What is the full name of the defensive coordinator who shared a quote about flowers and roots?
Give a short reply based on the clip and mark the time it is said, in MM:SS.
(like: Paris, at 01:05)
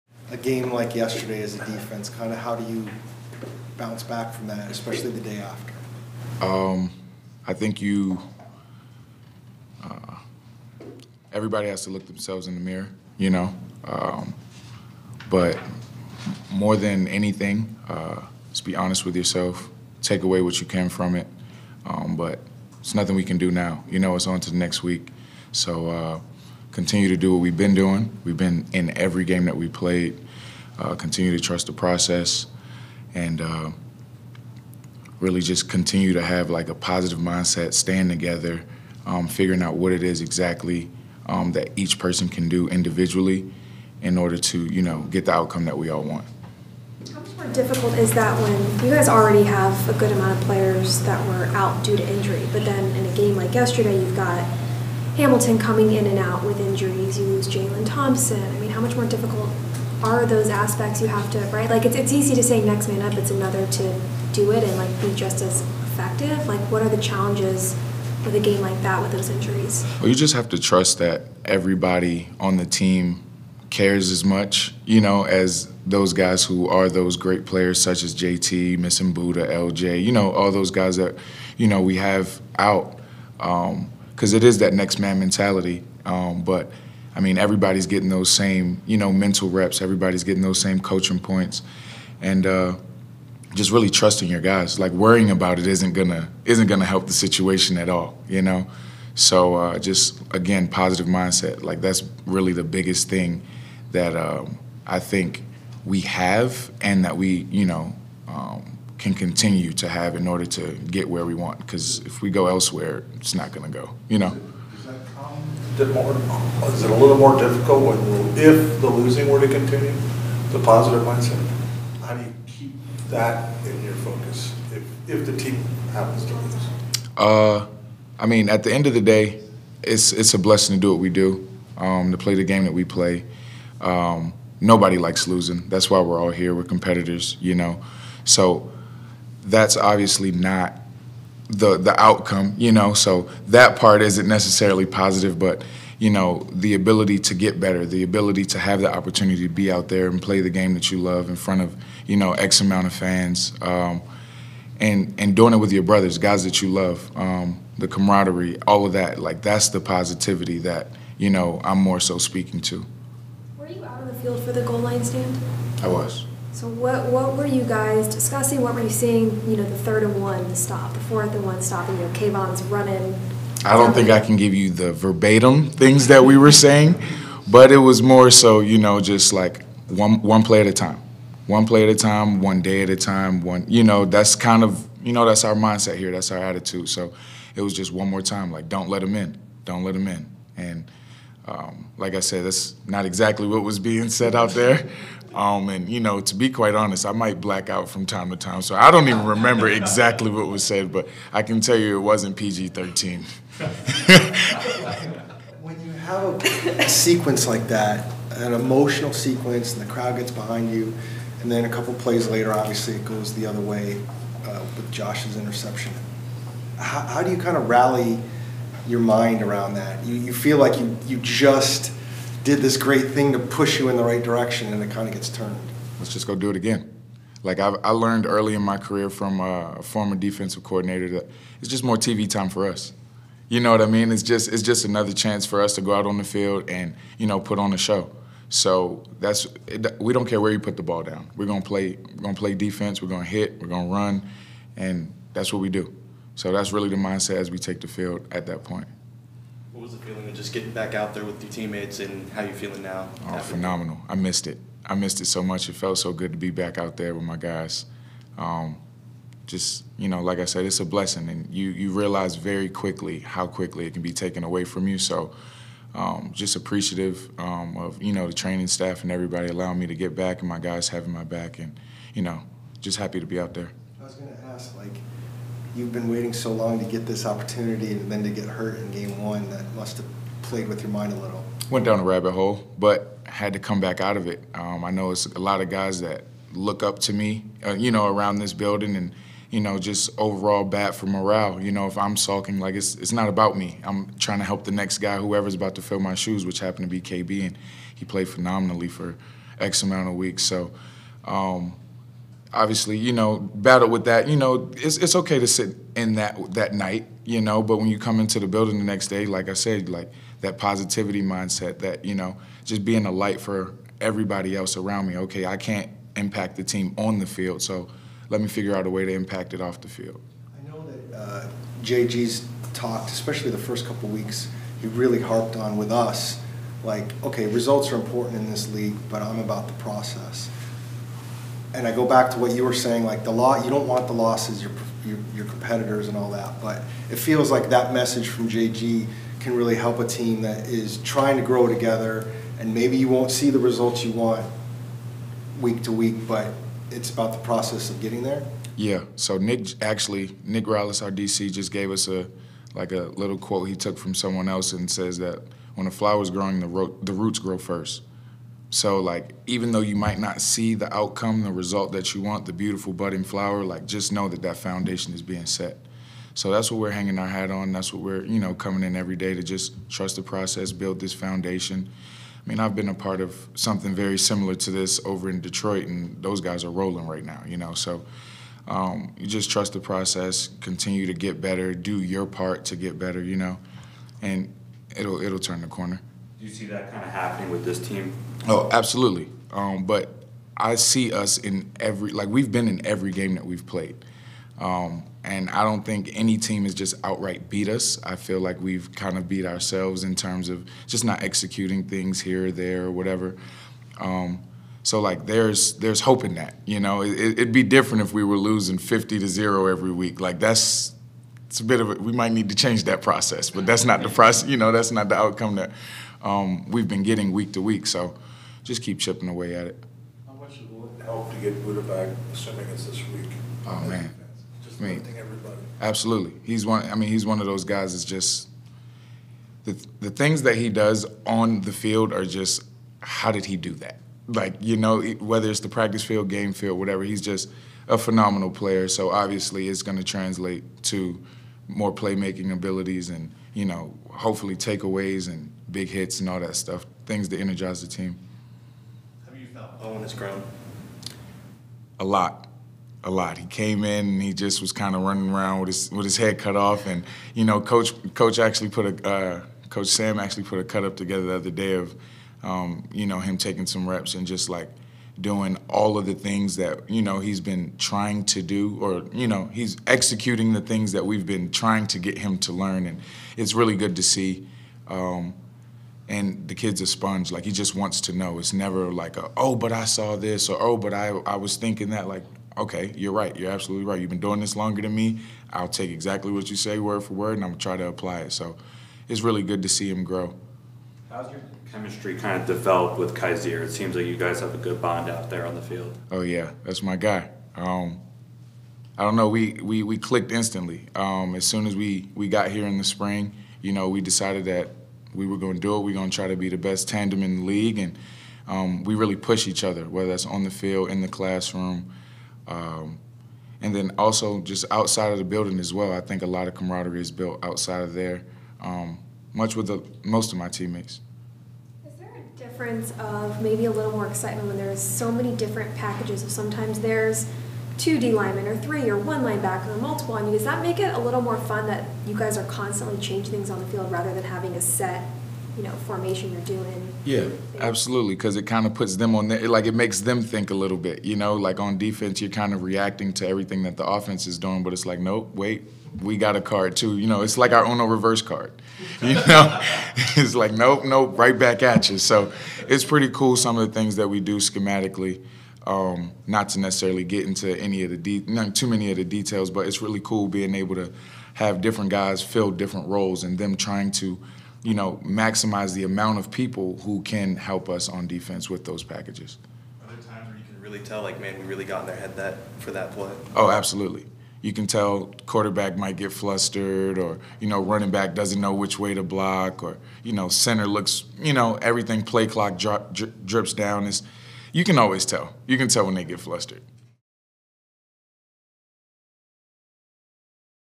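Nick Rallis, at 05:50.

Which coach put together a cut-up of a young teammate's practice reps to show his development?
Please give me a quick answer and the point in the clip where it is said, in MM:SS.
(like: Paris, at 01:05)
Coach Sam, at 07:39.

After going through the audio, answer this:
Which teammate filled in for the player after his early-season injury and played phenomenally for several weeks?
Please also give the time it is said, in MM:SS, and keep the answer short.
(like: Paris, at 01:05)
KB, at 04:56.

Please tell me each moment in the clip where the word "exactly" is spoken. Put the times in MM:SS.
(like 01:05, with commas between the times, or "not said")
00:40, 03:13, 03:19, 08:05.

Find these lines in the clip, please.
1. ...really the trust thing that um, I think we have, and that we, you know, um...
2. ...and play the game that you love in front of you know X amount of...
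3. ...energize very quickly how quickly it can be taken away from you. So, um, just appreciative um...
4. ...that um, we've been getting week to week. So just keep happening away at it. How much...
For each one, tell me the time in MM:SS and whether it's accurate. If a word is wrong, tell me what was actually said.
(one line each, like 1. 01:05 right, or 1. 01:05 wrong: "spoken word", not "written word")
1. 01:42 wrong: "biggest", not "trust"
2. 02:30 right
3. 04:21 wrong: "realize", not "energize"
4. 06:55 wrong: "chipping", not "happening".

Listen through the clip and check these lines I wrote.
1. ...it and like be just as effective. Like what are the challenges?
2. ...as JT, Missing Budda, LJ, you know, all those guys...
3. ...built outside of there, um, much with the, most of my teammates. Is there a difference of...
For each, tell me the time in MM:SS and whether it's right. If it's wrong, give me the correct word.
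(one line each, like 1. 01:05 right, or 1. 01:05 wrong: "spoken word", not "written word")
1. 01:04 right
2. 01:18 right
3. 08:37 right.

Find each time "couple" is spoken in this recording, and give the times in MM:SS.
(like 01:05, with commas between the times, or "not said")
03:31, 05:23.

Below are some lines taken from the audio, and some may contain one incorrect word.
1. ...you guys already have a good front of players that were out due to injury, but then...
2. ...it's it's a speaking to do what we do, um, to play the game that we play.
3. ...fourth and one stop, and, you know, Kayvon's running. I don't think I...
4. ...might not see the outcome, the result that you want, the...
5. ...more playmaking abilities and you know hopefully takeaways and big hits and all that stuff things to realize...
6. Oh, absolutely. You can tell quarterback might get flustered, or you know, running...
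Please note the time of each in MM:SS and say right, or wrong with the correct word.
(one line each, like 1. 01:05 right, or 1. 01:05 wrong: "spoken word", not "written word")
1. 00:48 wrong: "amount", not "front"
2. 02:09 wrong: "blessing", not "speaking"
3. 02:50 right
4. 05:59 right
5. 07:21 wrong: "energize", not "realize"
6. 09:33 right.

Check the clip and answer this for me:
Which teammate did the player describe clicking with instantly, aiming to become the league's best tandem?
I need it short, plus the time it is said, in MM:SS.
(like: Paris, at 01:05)
Kyzir, at 08:13.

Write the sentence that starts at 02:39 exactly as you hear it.
Like that's the positivity that you know I'm more so speaking to.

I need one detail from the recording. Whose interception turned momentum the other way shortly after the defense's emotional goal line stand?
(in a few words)
Josh.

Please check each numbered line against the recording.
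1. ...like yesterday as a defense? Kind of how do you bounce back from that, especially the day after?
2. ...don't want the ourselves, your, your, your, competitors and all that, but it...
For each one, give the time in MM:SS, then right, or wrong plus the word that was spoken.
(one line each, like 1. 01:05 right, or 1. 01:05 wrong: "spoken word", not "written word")
1. 00:00 right
2. 05:33 wrong: "losses", not "ourselves".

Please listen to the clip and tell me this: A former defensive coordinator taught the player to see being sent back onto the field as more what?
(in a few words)
TV time.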